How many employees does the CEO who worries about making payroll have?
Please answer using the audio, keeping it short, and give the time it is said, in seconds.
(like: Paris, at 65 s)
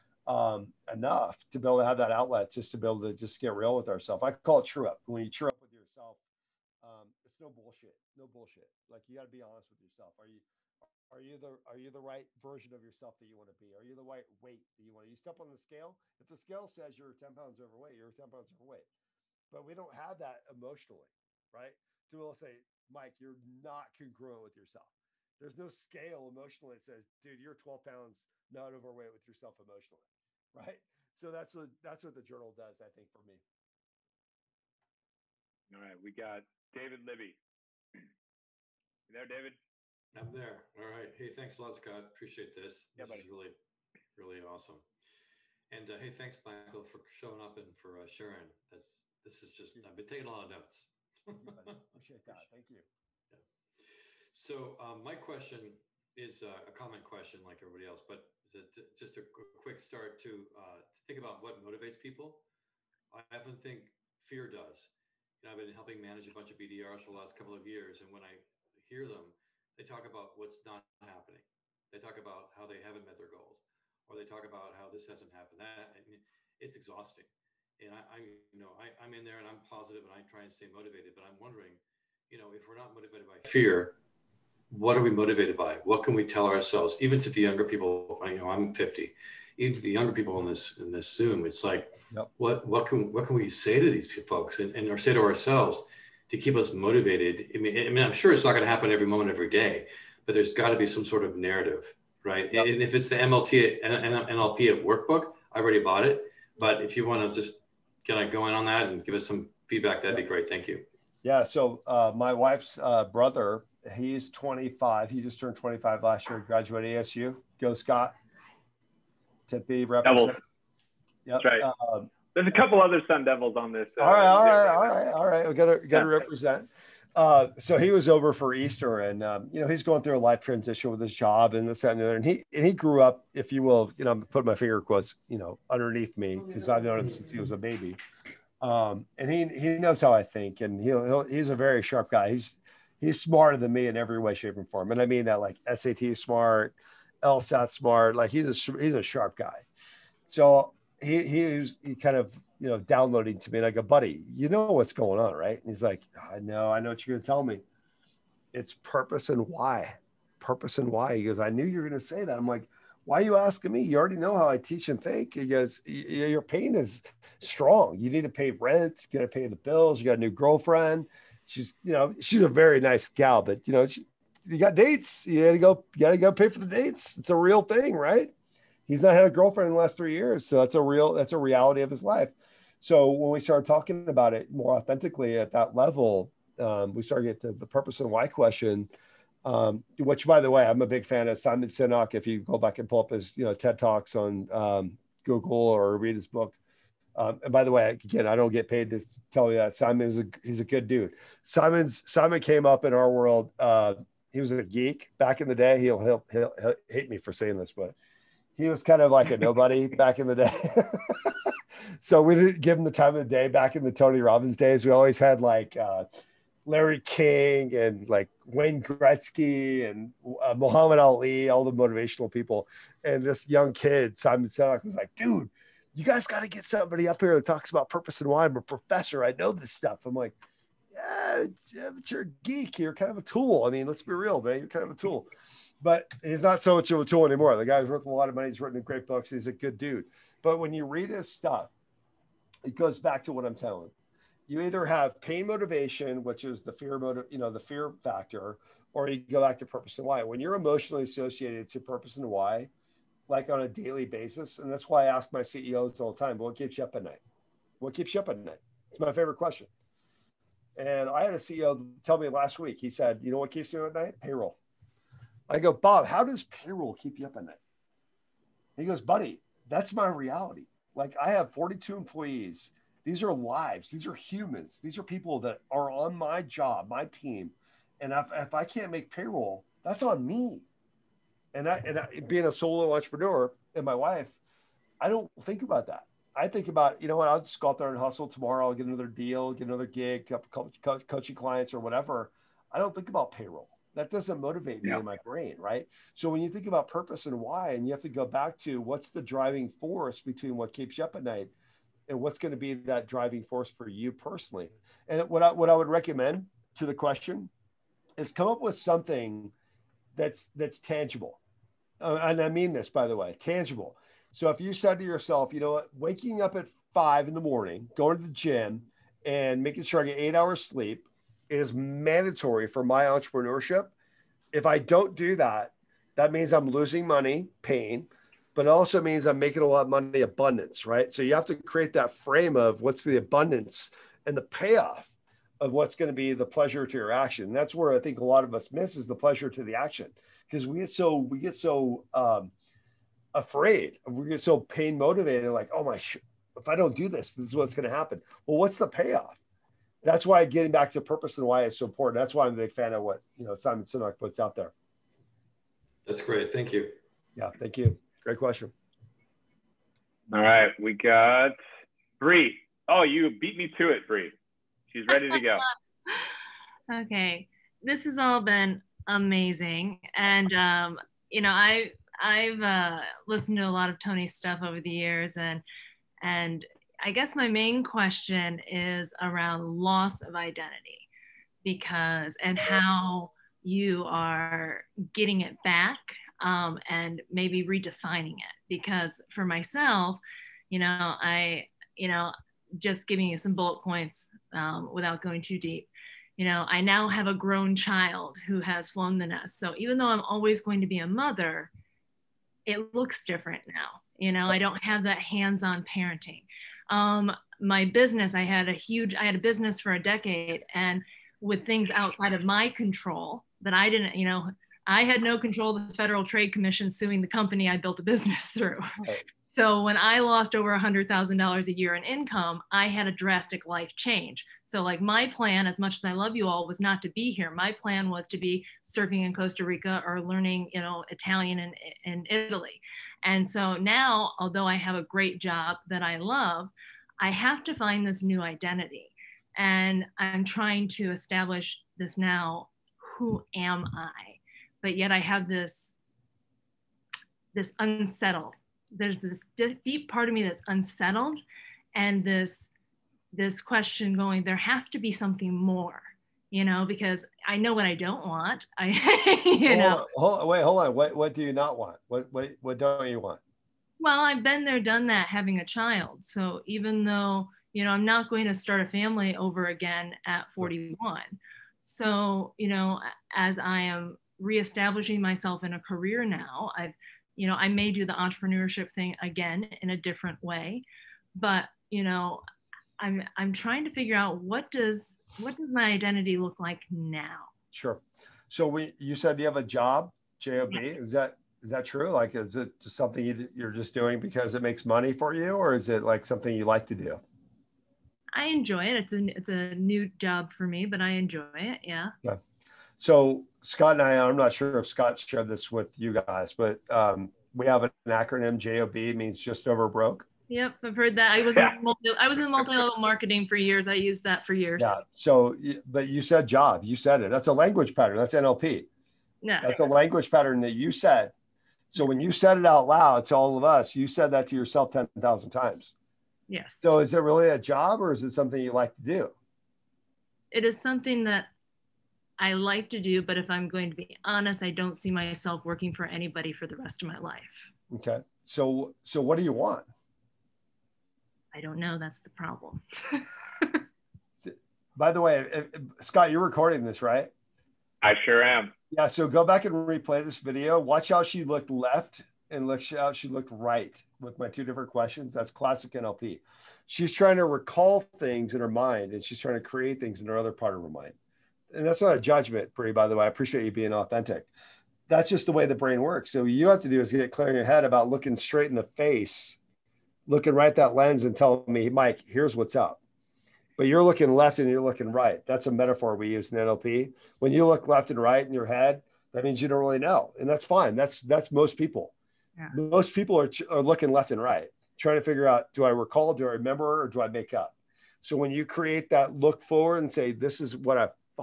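42, at 271 s.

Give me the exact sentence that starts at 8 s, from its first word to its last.
Like you got to be honest with yourself.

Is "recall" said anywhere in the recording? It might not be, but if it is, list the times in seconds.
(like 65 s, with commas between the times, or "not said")
557 s, 585 s.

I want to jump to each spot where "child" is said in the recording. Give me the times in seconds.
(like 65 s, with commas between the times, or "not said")
397 s, 465 s.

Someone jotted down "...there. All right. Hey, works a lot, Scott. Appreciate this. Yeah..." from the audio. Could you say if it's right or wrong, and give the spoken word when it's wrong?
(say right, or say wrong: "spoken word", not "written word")
wrong: "thanks", not "works".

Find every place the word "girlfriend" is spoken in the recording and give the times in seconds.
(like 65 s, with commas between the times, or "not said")
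170 s, 179 s.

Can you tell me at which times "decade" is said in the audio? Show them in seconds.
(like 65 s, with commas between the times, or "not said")
410 s.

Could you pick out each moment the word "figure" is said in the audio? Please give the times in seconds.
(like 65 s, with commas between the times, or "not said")
483 s, 585 s.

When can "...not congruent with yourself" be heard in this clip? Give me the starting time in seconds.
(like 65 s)
23 s.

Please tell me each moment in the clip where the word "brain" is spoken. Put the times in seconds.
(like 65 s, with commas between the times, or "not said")
295 s, 565 s.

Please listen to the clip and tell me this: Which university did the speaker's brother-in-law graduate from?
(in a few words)
ASU.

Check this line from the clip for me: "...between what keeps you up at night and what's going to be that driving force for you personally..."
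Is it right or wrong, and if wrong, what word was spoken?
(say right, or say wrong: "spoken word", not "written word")
right.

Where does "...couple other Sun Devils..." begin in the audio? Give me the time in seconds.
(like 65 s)
122 s.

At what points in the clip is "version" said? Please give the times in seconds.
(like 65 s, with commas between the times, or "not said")
12 s.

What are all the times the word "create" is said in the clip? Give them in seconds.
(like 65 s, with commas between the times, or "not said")
331 s, 559 s, 588 s.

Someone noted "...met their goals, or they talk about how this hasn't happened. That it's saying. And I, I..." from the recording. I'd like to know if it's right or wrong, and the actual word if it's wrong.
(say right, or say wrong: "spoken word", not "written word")
wrong: "exhausting", not "saying".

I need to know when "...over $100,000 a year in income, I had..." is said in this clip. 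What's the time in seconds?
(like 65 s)
420 s.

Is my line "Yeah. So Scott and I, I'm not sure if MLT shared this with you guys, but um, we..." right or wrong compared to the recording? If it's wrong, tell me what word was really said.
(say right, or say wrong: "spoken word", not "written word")
wrong: "Scott", not "MLT".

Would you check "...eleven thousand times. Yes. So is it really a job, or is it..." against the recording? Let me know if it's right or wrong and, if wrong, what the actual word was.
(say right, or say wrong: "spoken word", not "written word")
wrong: "ten", not "eleven".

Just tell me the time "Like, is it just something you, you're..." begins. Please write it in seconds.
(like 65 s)
492 s.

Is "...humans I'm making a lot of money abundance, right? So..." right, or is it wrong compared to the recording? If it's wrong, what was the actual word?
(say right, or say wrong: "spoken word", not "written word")
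wrong: "means", not "humans".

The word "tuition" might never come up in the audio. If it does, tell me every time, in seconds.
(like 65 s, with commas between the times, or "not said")
not said.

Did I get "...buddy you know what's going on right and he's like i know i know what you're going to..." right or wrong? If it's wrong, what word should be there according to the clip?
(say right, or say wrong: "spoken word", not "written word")
right.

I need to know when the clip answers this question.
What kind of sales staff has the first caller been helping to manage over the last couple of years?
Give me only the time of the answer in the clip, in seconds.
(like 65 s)
66 s.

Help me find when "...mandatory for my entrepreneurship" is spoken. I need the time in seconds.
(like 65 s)
321 s.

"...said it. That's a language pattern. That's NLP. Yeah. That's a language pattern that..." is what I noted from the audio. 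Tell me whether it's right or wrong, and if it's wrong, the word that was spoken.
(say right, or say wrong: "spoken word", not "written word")
right.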